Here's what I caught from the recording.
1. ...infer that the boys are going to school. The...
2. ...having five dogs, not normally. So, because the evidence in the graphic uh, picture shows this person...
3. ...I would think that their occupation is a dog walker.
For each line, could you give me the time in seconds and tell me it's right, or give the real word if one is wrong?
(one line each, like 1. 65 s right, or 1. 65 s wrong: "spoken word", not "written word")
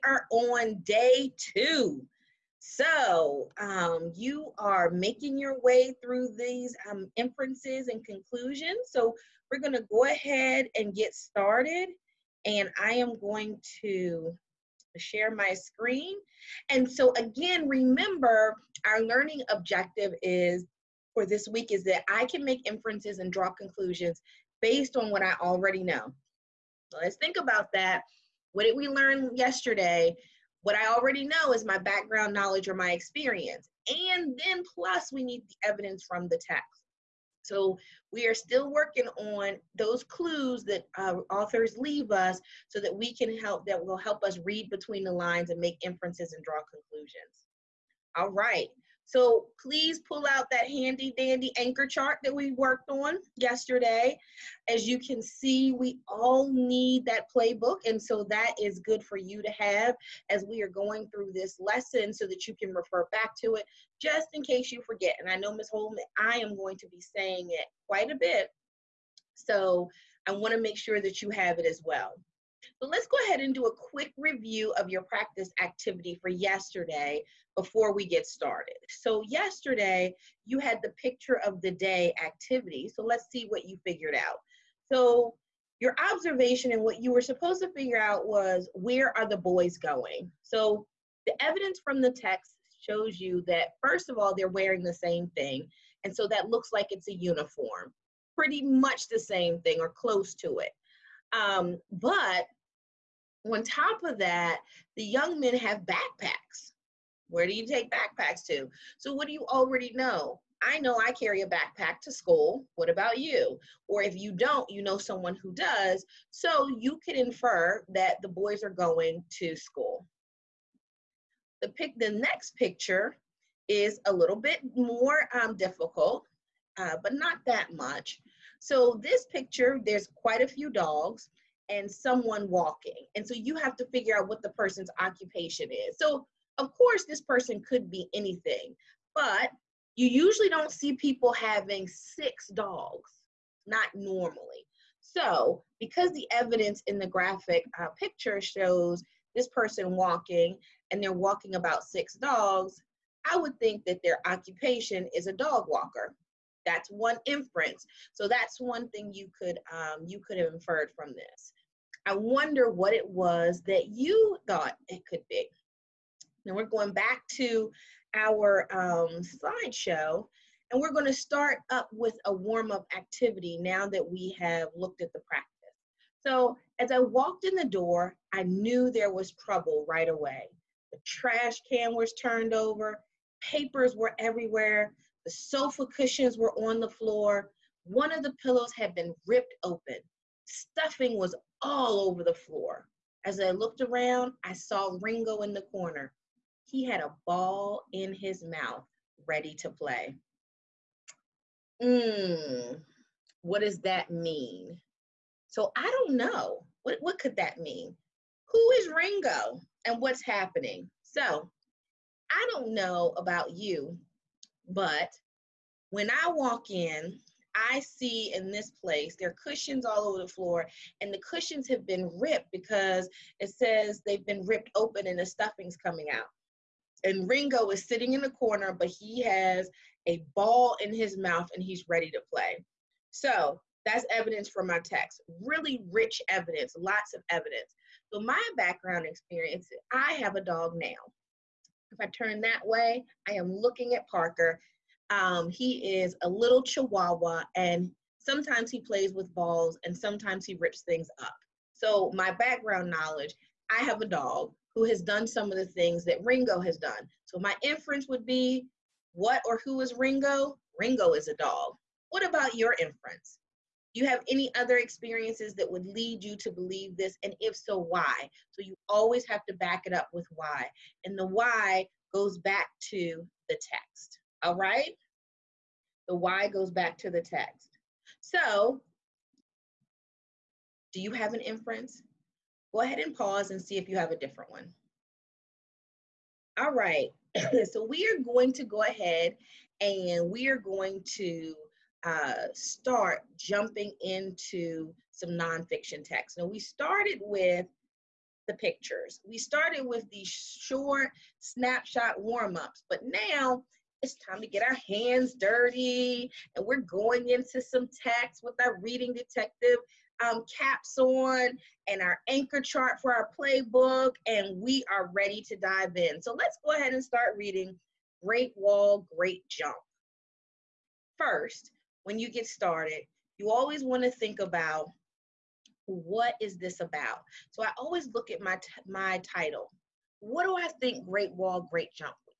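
1. 117 s right
2. 141 s wrong: "six", not "five"
3. 153 s right.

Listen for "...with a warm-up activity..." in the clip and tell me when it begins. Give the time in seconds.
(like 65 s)
171 s.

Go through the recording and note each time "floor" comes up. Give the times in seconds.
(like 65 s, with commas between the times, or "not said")
186 s, 192 s, 220 s.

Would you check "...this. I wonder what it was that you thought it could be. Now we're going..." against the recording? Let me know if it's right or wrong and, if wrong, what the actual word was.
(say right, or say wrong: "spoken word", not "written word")
right.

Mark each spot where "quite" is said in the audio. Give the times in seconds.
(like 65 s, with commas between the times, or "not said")
67 s, 130 s.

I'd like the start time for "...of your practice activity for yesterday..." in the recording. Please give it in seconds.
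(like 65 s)
74 s.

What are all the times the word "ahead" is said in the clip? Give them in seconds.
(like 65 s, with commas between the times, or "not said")
10 s, 73 s, 282 s, 288 s, 316 s.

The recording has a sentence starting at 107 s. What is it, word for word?
Where do you take backpacks to?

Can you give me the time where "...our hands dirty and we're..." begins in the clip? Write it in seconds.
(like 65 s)
304 s.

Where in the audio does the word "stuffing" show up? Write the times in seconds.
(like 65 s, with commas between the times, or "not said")
190 s, 225 s.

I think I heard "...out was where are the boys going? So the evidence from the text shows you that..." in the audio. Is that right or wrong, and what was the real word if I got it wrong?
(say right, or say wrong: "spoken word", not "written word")
right.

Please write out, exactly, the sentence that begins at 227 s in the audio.
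And Ringo is sitting in the corner, but he has a ball in his mouth and he's ready to play.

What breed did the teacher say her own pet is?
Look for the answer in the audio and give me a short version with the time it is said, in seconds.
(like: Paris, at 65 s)
Chihuahua, at 246 s.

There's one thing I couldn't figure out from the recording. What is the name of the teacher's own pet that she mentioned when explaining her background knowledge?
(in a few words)
Parker.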